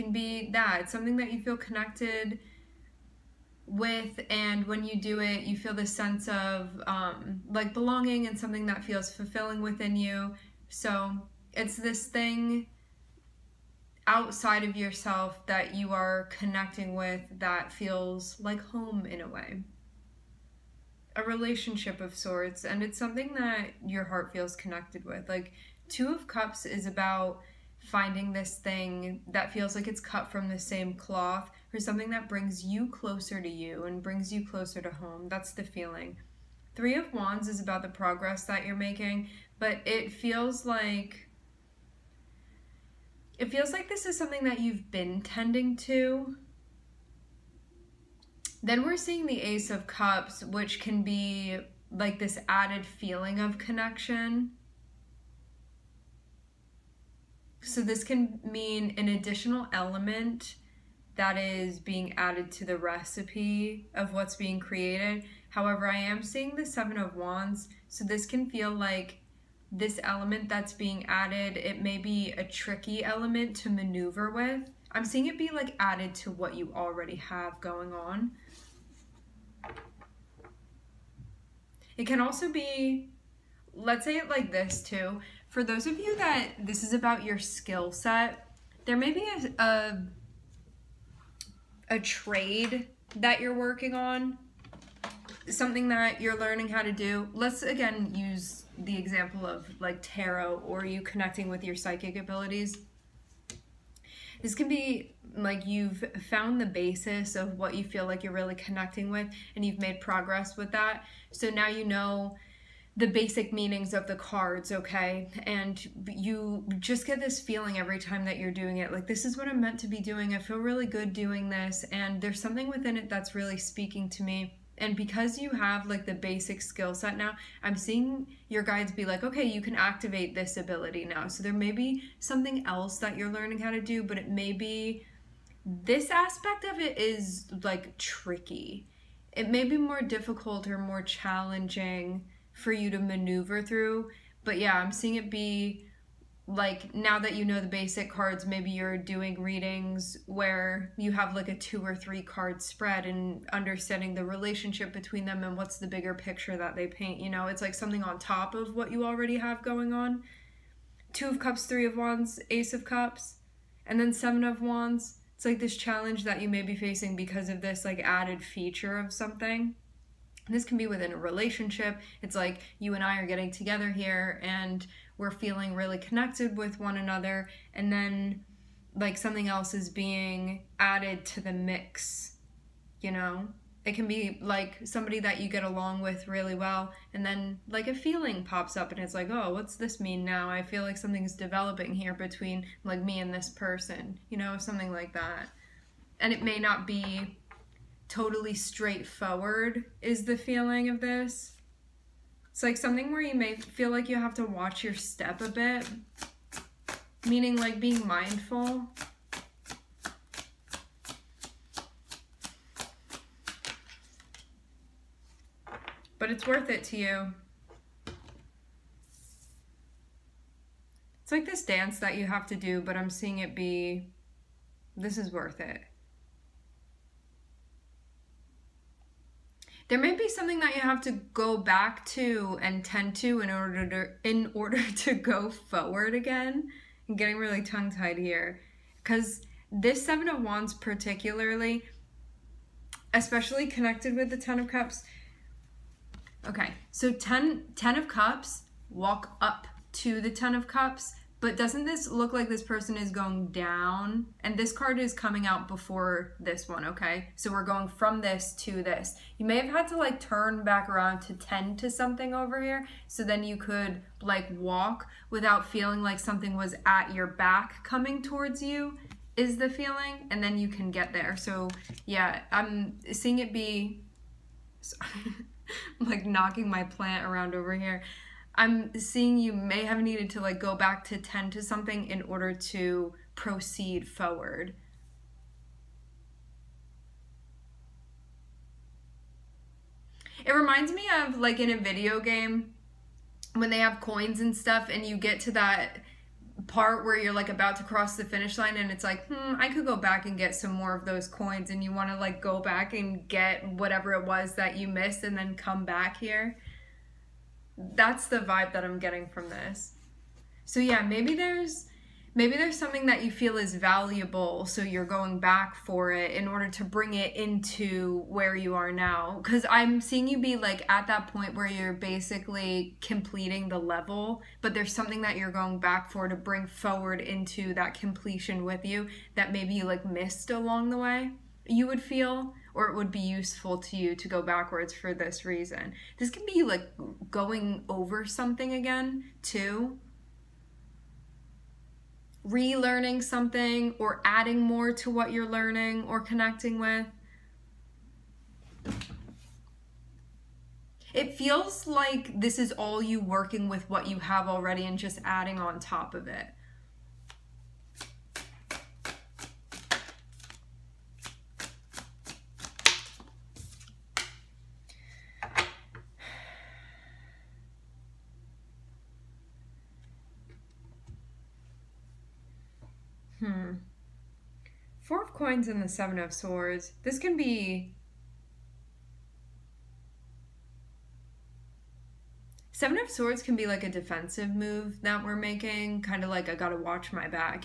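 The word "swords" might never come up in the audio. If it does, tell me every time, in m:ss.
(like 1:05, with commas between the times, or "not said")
6:16, 6:23.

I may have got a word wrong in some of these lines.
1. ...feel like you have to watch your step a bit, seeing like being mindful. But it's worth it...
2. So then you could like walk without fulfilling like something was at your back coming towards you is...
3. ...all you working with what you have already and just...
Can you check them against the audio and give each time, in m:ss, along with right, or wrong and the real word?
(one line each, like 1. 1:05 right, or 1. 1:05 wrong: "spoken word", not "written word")
1. 3:23 wrong: "meaning", not "seeing"
2. 4:23 wrong: "feeling", not "fulfilling"
3. 5:52 right.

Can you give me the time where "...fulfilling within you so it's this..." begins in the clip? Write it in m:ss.
0:09.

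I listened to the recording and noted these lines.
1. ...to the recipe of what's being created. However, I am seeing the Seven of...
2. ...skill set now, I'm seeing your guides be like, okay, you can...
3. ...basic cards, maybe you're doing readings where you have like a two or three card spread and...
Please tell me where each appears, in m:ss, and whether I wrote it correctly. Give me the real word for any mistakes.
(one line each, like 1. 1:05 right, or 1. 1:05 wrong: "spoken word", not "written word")
1. 1:02 right
2. 2:06 right
3. 2:27 right.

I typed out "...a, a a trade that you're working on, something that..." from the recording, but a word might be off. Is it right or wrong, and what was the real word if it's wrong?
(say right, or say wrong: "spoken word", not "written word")
right.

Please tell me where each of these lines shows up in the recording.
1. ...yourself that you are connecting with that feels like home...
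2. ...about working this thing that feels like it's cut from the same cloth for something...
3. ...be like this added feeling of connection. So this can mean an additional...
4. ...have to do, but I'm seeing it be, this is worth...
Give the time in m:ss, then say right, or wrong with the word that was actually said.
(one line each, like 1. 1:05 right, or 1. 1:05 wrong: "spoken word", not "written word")
1. 0:14 right
2. 0:26 wrong: "finding", not "working"
3. 0:51 right
4. 3:42 right.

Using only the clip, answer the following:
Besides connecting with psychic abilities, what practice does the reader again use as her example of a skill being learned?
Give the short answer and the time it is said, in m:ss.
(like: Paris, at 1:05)
tarot, at 1:40.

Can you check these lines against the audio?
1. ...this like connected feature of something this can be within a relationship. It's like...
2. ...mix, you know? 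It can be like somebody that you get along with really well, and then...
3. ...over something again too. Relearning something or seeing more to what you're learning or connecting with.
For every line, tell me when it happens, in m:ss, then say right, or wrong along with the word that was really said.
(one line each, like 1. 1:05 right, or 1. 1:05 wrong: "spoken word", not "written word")
1. 2:47 wrong: "added", not "connected"
2. 3:01 right
3. 5:37 wrong: "adding", not "seeing".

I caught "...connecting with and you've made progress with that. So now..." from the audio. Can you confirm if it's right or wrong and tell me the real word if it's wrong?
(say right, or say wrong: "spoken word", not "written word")
right.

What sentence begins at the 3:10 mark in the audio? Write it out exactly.
I feel like something's developing here between like me and this person, you know, something like that.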